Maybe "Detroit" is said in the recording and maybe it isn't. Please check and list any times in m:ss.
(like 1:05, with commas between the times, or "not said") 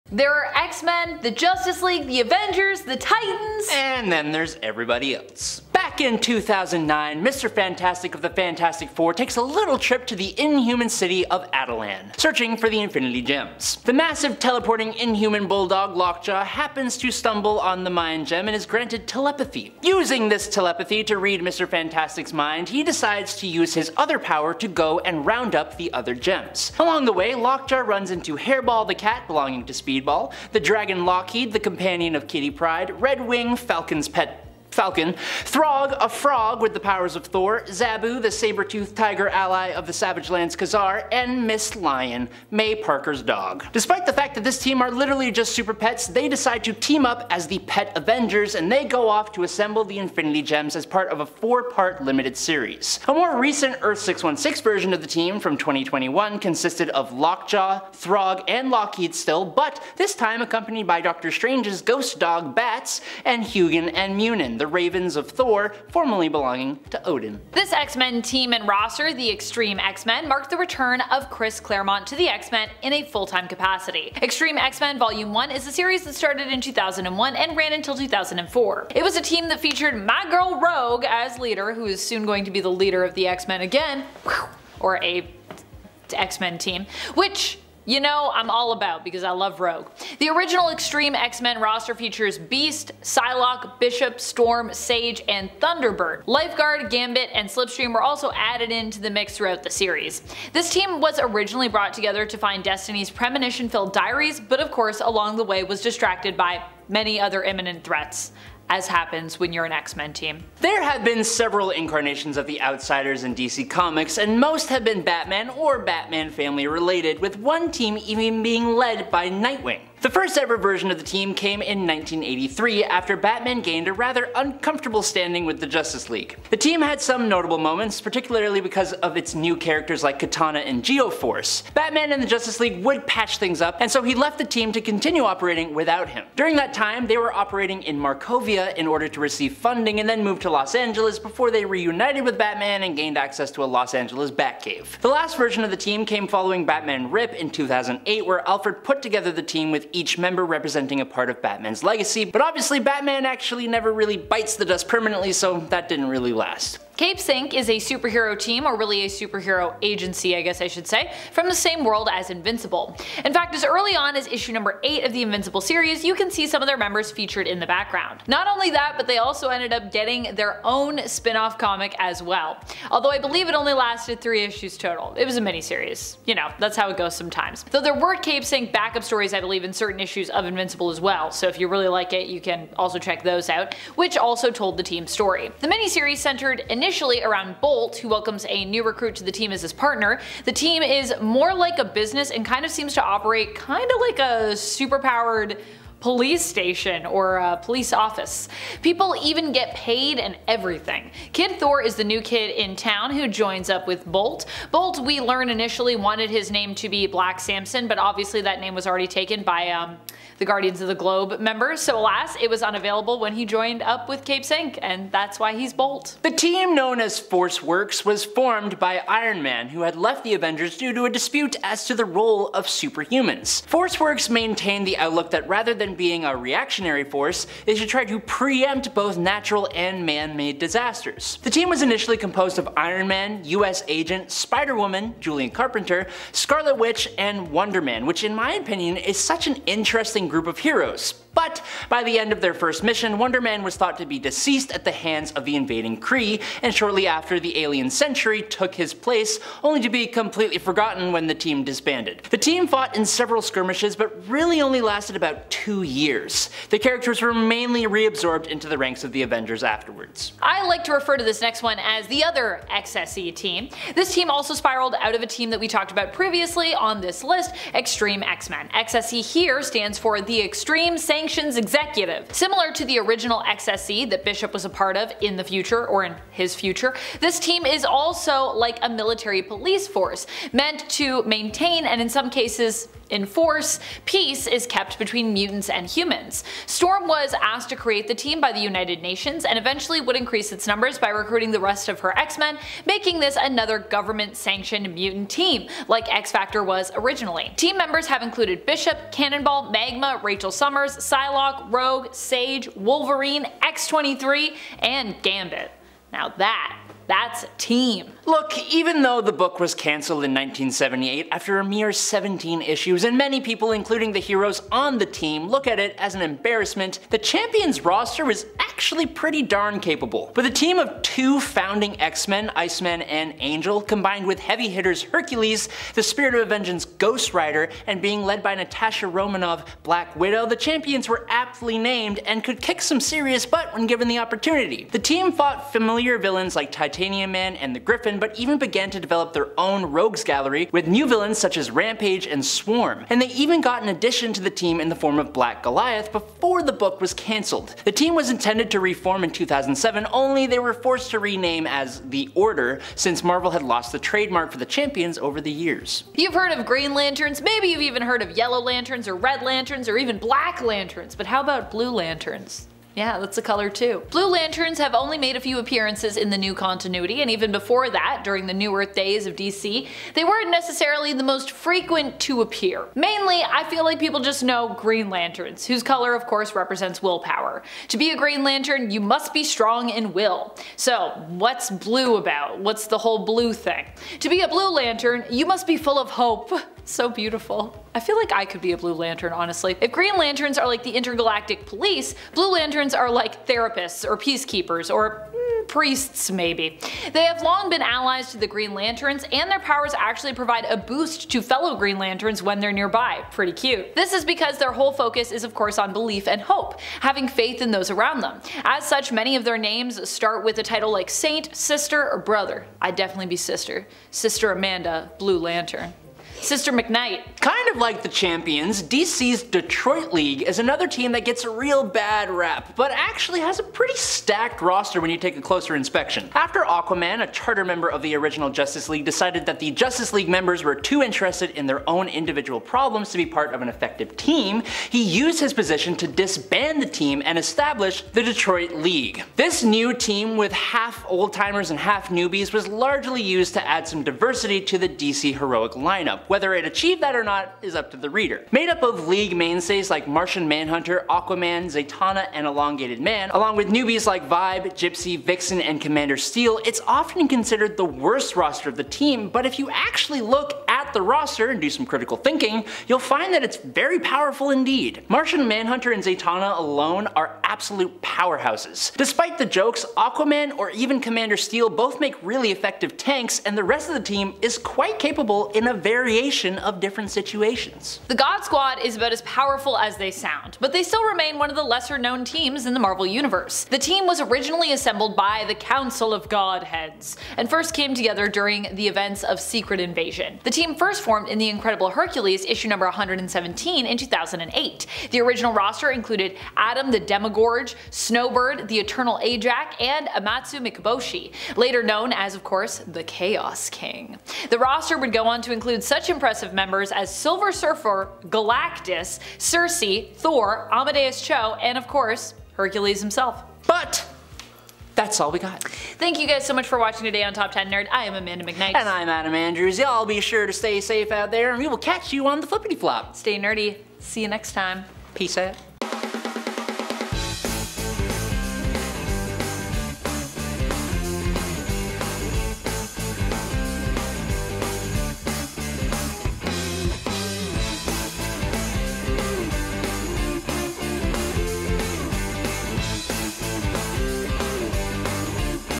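6:59, 7:18.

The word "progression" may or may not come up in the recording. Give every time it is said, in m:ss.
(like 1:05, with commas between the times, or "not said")
not said.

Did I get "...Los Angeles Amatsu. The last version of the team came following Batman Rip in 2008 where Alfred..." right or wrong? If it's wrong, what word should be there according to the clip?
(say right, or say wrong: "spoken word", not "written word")
wrong: "Batcave", not "Amatsu".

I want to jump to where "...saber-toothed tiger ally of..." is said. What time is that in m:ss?
0:38.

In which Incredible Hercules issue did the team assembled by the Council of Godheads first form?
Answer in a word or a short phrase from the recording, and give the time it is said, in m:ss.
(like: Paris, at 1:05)
117, at 8:12.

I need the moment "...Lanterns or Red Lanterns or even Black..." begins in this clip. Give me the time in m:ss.
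5:58.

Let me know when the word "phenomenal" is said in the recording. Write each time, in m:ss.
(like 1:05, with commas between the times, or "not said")
not said.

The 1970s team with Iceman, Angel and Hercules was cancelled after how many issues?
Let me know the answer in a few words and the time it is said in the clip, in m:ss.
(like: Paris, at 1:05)
17, at 5:11.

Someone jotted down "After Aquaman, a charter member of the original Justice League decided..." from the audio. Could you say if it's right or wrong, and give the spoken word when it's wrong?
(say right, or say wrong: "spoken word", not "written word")
right.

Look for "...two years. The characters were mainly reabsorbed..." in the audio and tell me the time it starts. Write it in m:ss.
4:15.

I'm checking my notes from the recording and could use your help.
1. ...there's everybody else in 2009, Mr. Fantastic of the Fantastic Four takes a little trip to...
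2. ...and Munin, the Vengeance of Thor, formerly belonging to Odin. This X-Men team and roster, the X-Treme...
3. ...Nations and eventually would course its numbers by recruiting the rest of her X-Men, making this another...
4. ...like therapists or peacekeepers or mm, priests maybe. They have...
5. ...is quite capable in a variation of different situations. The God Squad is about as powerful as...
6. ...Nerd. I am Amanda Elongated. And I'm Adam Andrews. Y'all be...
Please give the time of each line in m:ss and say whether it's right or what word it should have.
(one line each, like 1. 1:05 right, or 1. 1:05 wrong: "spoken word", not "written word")
1. 0:04 right
2. 1:03 wrong: "Ravens", not "Vengeance"
3. 4:49 wrong: "increase", not "course"
4. 6:33 right
5. 7:54 right
6. 8:37 wrong: "McKnight", not "Elongated".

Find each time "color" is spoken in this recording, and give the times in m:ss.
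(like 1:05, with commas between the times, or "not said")
6:03, 6:15.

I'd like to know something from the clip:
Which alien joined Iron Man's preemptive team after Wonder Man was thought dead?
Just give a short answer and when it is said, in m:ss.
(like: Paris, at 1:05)
Century, at 4:07.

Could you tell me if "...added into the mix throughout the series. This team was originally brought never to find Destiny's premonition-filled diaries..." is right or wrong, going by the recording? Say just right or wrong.
wrong.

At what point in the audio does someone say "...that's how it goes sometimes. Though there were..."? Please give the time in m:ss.
2:56.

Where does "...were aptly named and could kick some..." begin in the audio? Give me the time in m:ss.
5:31.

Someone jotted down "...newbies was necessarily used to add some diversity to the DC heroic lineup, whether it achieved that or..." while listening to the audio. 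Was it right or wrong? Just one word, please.
wrong.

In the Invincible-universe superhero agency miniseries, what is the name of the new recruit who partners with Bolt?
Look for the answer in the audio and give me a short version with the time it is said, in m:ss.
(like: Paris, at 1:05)
Kid Thor, at 3:21.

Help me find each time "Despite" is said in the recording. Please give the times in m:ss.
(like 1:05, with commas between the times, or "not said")
0:43, 7:48.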